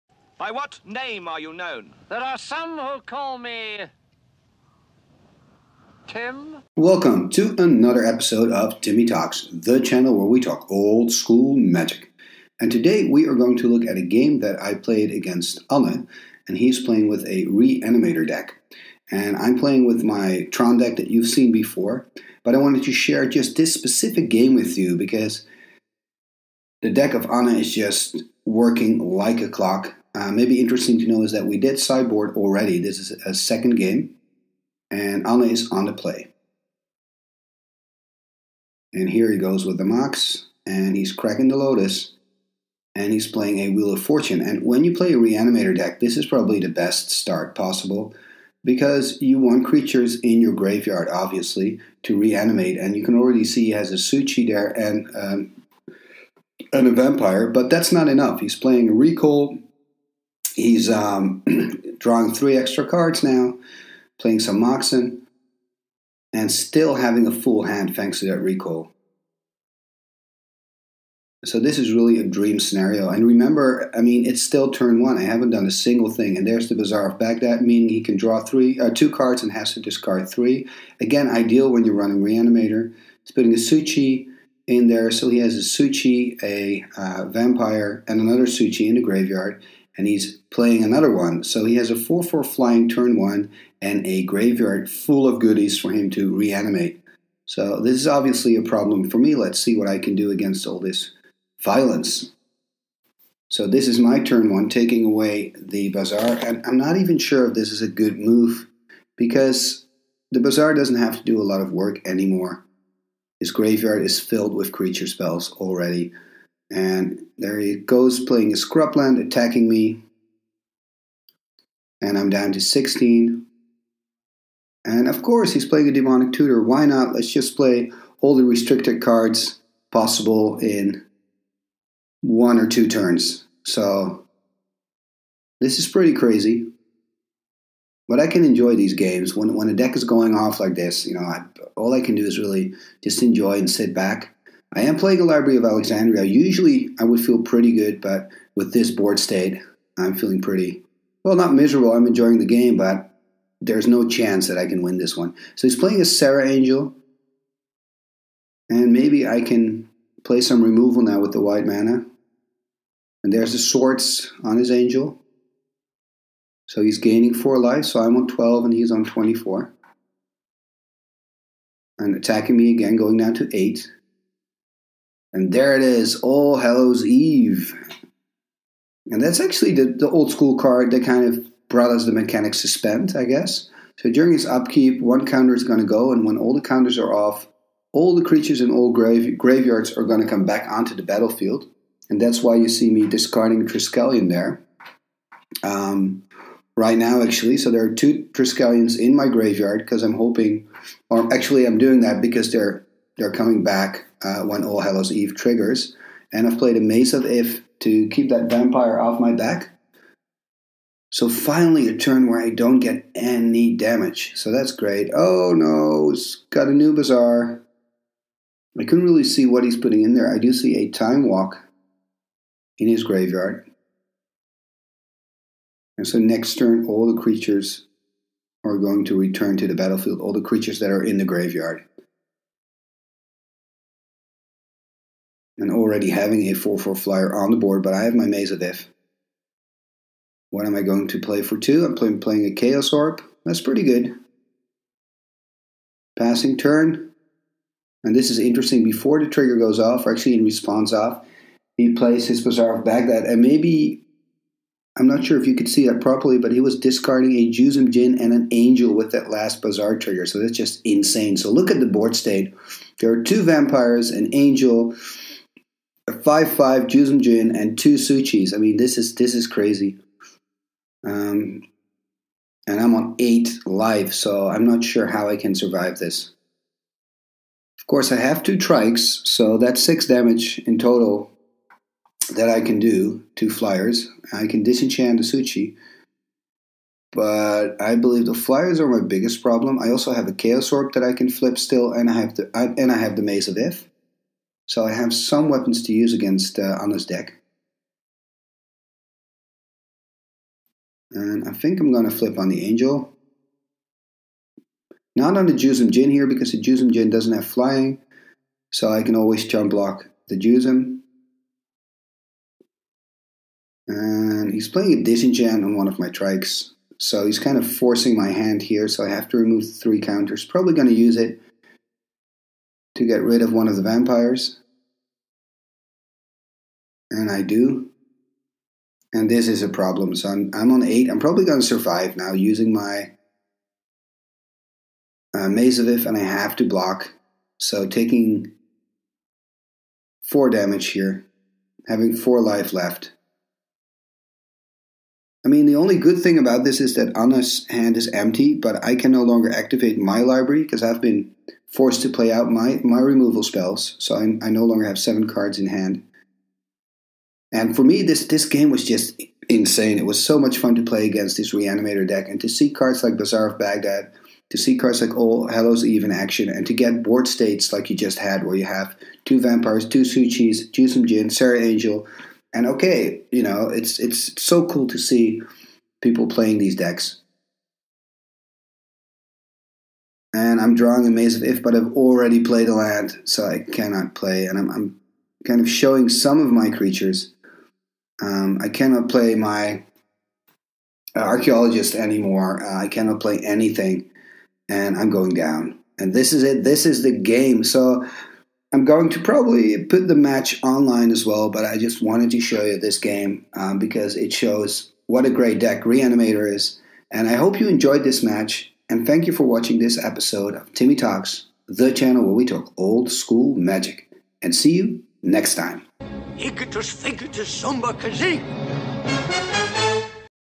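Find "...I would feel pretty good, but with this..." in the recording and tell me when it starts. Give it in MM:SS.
02:26.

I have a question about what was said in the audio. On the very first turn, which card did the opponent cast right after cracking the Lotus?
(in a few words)
Wheel of Fortune.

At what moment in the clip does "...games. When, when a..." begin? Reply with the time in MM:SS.
02:18.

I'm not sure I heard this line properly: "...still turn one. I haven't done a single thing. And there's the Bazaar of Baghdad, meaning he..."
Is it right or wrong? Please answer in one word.
right.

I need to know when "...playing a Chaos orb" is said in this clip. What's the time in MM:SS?
04:02.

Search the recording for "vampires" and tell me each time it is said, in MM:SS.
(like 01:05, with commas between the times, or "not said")
00:56, 01:27, 03:28, 04:23, 05:23, 06:09.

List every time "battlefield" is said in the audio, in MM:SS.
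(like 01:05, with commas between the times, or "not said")
03:11, 03:49.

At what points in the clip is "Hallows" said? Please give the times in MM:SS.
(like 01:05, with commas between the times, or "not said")
02:56, 03:24, 06:05.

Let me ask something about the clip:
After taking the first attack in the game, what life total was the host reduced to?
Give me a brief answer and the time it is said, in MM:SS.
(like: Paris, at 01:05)
16, at 02:02.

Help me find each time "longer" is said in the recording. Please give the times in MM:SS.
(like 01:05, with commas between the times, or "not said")
05:49, 05:54.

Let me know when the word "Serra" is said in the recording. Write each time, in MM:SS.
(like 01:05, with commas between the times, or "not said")
02:36, 06:11.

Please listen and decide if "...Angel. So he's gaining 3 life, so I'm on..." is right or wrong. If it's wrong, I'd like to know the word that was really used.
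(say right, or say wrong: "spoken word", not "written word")
wrong: "4", not "3".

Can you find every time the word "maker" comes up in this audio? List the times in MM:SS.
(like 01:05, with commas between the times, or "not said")
not said.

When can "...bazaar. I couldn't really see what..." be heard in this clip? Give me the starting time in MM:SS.
03:36.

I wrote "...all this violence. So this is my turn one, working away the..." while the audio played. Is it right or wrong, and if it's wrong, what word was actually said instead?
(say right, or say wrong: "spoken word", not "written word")
wrong: "taking", not "working".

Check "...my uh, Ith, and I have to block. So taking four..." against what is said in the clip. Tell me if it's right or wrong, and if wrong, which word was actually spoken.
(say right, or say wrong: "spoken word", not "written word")
right.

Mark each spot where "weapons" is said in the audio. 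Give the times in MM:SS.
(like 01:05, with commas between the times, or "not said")
04:55.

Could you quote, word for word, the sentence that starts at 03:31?
So finally, a turn where I don't get any damage.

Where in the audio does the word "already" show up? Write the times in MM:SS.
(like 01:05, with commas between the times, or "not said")
00:32, 00:53, 01:55, 03:55, 06:21.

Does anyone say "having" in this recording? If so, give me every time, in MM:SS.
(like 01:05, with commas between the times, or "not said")
01:06, 03:56, 05:41.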